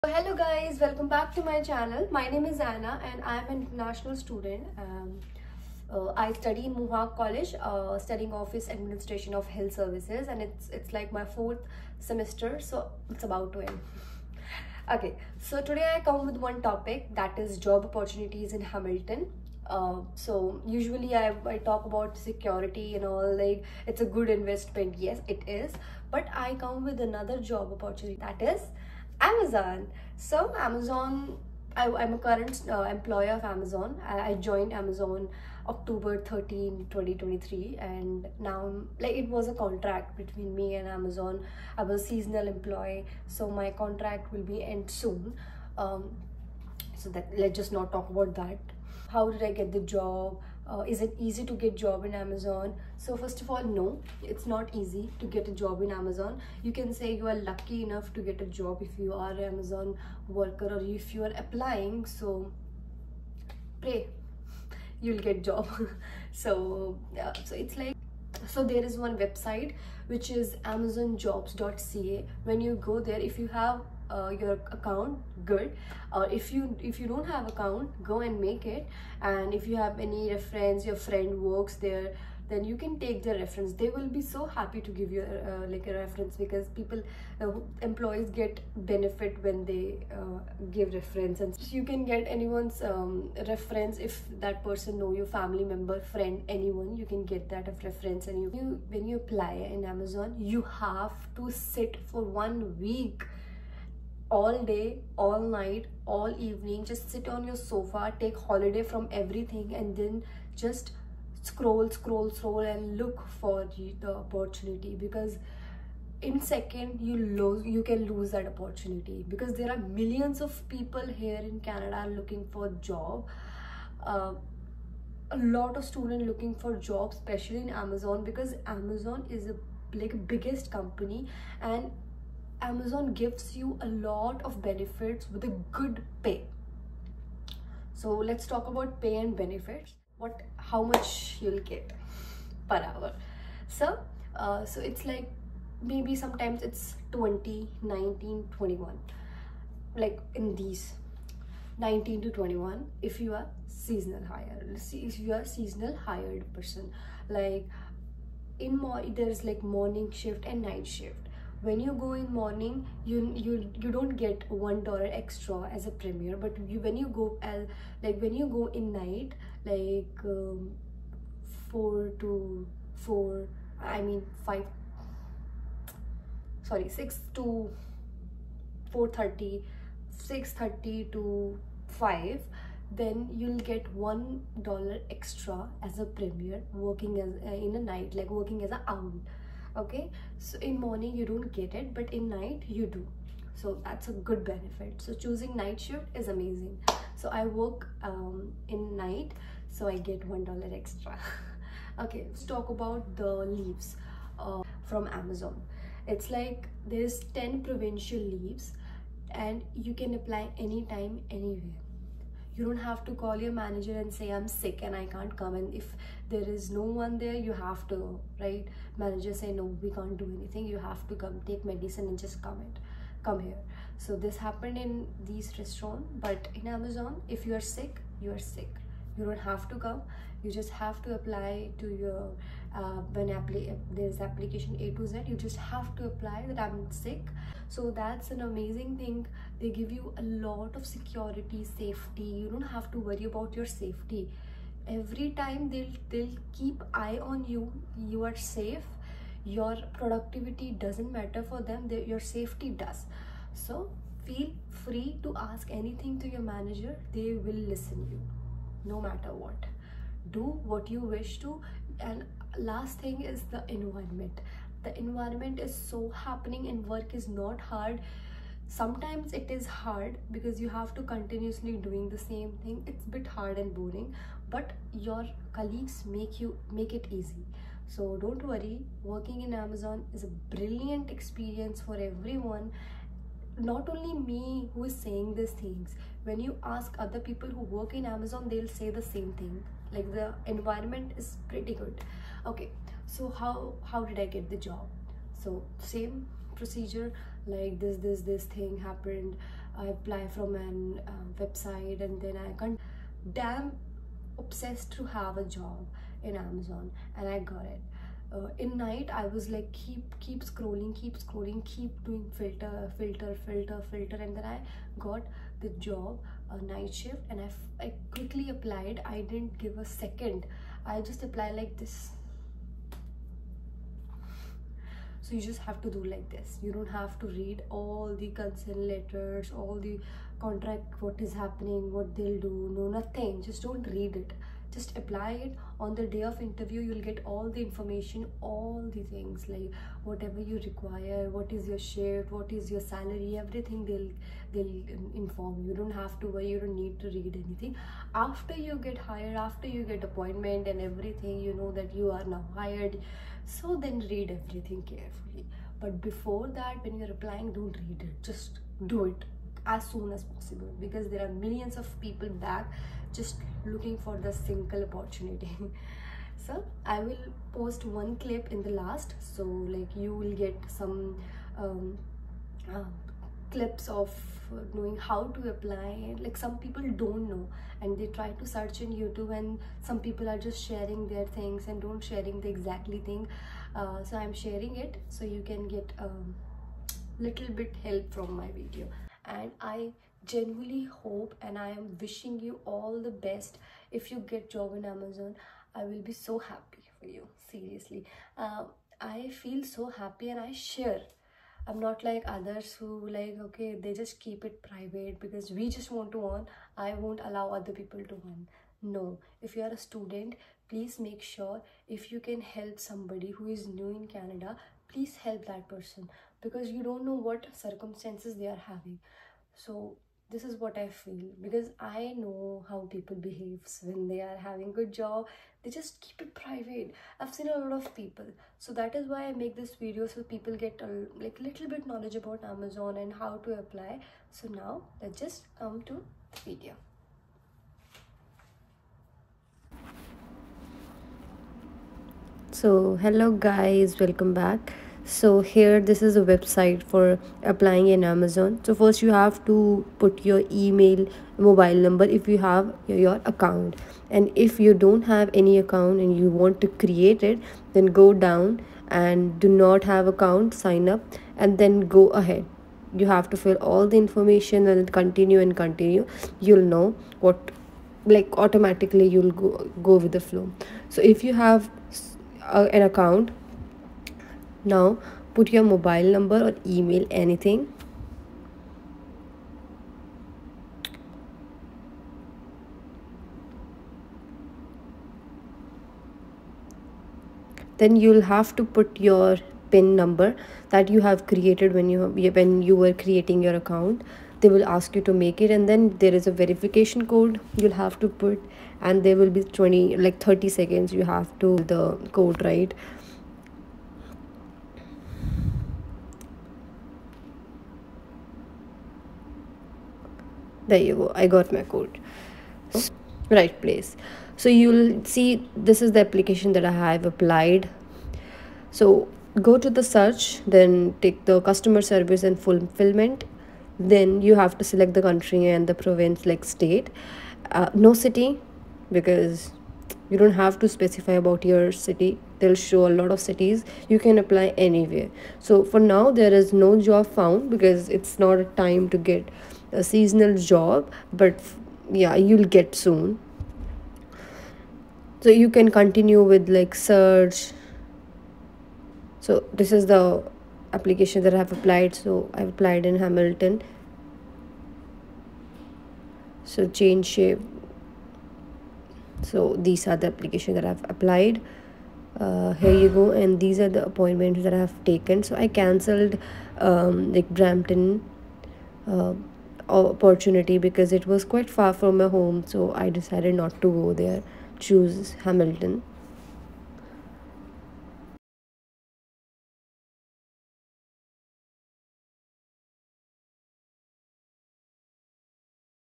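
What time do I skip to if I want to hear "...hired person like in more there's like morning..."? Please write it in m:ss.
2:36.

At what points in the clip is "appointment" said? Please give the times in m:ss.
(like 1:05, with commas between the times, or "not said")
5:50, 9:23.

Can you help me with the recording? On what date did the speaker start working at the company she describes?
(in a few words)
October 13, 2023.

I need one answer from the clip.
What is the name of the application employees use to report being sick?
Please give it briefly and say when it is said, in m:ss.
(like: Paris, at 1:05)
A to Z, at 3:54.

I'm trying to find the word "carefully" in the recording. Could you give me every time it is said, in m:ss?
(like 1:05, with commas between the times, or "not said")
5:54.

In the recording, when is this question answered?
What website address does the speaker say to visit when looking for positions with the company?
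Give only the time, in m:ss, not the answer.
1:10.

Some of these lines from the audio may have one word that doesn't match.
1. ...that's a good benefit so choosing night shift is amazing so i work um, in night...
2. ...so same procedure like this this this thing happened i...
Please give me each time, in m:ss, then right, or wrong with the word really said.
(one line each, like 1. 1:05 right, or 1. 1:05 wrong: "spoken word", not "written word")
1. 3:13 right
2. 4:55 right.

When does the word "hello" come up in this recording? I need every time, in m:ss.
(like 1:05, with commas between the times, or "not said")
0:00, 7:22.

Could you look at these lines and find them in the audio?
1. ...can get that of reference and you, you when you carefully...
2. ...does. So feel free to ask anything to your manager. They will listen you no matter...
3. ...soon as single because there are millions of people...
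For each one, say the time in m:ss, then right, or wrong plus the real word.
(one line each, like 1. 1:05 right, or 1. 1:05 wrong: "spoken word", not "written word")
1. 1:37 wrong: "apply", not "carefully"
2. 4:12 right
3. 5:59 wrong: "possible", not "single".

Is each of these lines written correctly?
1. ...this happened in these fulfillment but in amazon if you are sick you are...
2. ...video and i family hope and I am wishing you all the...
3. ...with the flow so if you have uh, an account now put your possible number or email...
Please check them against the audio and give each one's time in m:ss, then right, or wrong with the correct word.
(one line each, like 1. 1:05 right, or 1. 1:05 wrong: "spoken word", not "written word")
1. 3:44 wrong: "restaurant", not "fulfillment"
2. 6:28 wrong: "genuinely", not "family"
3. 7:49 wrong: "mobile", not "possible".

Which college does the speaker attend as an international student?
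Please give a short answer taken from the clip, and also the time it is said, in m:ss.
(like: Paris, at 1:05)
Mohawk College, at 0:06.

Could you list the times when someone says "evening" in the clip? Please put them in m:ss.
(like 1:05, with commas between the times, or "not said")
1:46.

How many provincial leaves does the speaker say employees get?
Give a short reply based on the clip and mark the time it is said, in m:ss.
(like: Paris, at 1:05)
10, at 3:27.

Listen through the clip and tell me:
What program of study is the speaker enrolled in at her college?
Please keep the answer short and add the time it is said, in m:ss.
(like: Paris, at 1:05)
Office administration of health services, at 0:08.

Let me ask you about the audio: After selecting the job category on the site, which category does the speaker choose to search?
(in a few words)
Customer service and fulfillment.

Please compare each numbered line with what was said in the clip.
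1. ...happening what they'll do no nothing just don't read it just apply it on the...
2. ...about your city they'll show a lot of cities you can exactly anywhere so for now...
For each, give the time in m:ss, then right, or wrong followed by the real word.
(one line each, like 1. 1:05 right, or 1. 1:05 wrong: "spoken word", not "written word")
1. 5:31 right
2. 8:51 wrong: "apply", not "exactly".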